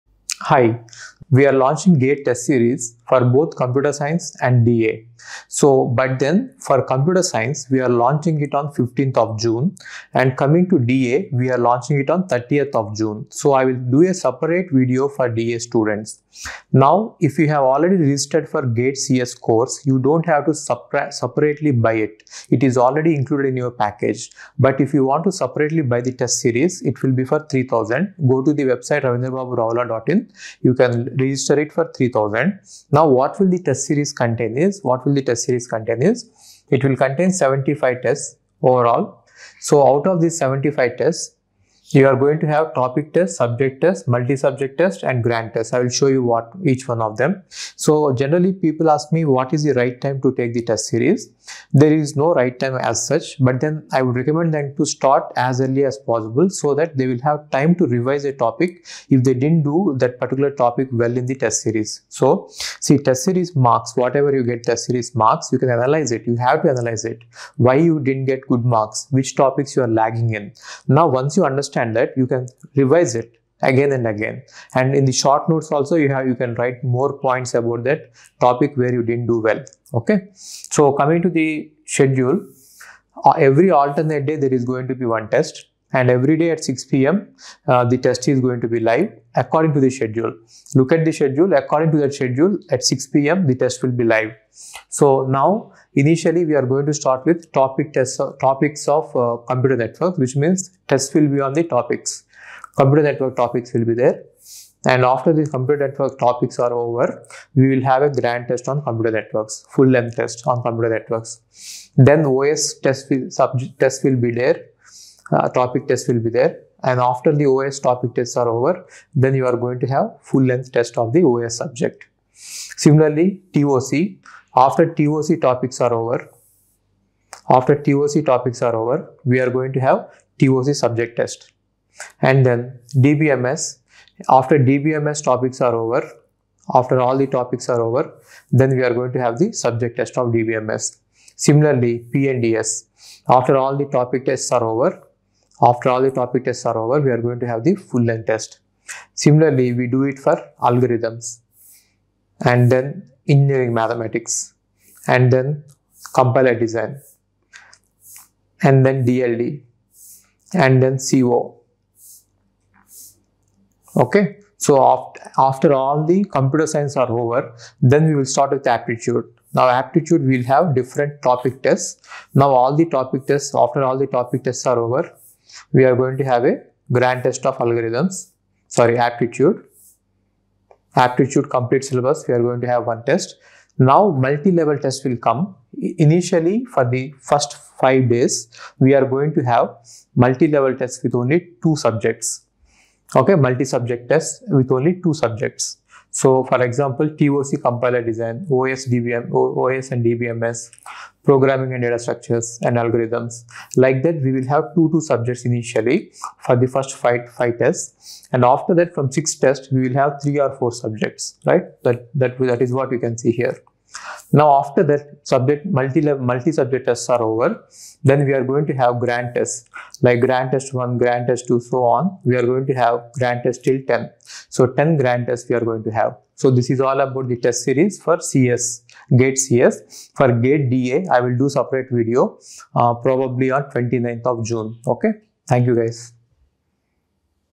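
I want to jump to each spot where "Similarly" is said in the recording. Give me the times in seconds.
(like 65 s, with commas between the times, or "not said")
122 s, 141 s, 149 s.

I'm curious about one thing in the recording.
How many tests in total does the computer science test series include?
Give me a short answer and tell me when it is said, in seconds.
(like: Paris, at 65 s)
75, at 37 s.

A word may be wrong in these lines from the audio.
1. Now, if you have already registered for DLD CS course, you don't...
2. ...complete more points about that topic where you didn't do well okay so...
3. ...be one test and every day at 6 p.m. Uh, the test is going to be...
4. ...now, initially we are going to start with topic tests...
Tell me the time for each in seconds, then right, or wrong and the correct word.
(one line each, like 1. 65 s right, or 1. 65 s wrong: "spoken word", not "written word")
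1. 16 s wrong: "GATE", not "DLD"
2. 76 s wrong: "write", not "complete"
3. 85 s right
4. 95 s right.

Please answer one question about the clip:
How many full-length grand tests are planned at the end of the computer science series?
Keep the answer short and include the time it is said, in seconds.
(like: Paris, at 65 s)
10, at 224 s.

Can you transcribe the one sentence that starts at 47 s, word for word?
So generally people ask me what is the right time to take the test series.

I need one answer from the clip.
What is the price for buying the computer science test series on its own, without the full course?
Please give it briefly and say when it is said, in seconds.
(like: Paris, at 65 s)
3000, at 26 s.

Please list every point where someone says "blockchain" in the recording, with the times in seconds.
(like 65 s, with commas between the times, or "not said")
not said.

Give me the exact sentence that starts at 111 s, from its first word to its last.
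Then OS test will, test will be there uh, topic test will be there.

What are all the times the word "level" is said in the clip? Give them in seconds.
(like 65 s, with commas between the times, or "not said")
184 s, 190 s.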